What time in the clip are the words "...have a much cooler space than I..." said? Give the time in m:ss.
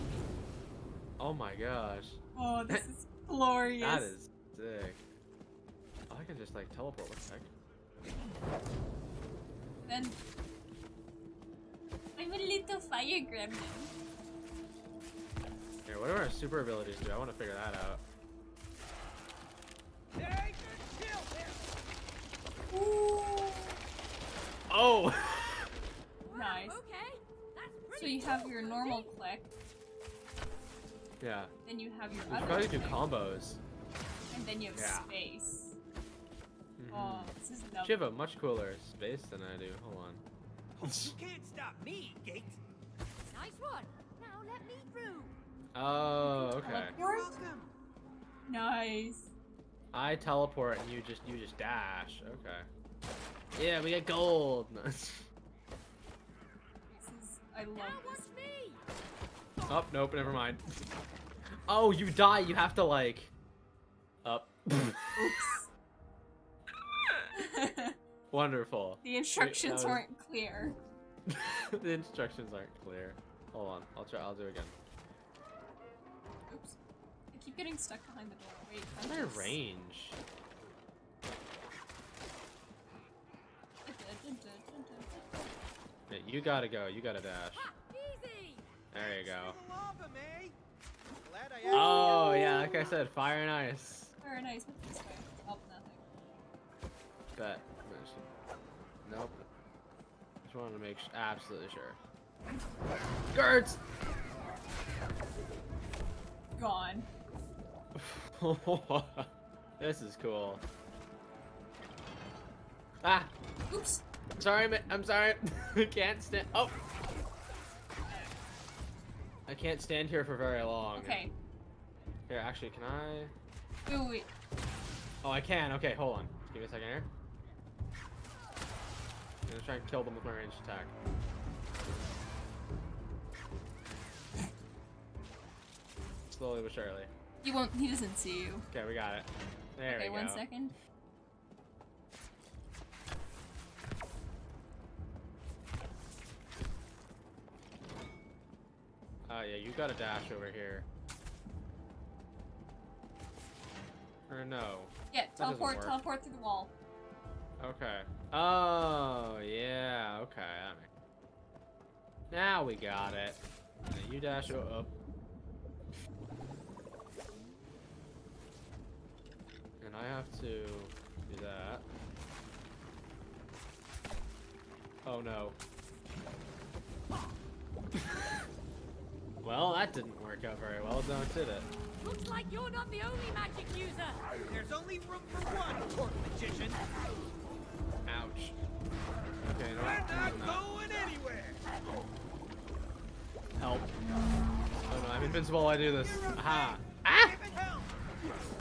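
0:37.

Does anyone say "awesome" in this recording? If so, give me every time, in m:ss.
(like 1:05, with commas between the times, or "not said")
not said.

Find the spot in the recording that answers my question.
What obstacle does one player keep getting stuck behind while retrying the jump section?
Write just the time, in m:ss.
1:18.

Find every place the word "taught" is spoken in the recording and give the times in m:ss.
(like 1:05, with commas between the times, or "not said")
not said.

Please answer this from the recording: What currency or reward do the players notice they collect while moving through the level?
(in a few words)
gold.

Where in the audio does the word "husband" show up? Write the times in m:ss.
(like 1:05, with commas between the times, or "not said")
not said.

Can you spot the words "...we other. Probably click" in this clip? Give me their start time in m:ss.
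0:32.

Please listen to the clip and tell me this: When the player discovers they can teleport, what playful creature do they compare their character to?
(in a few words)
little fire gremlin.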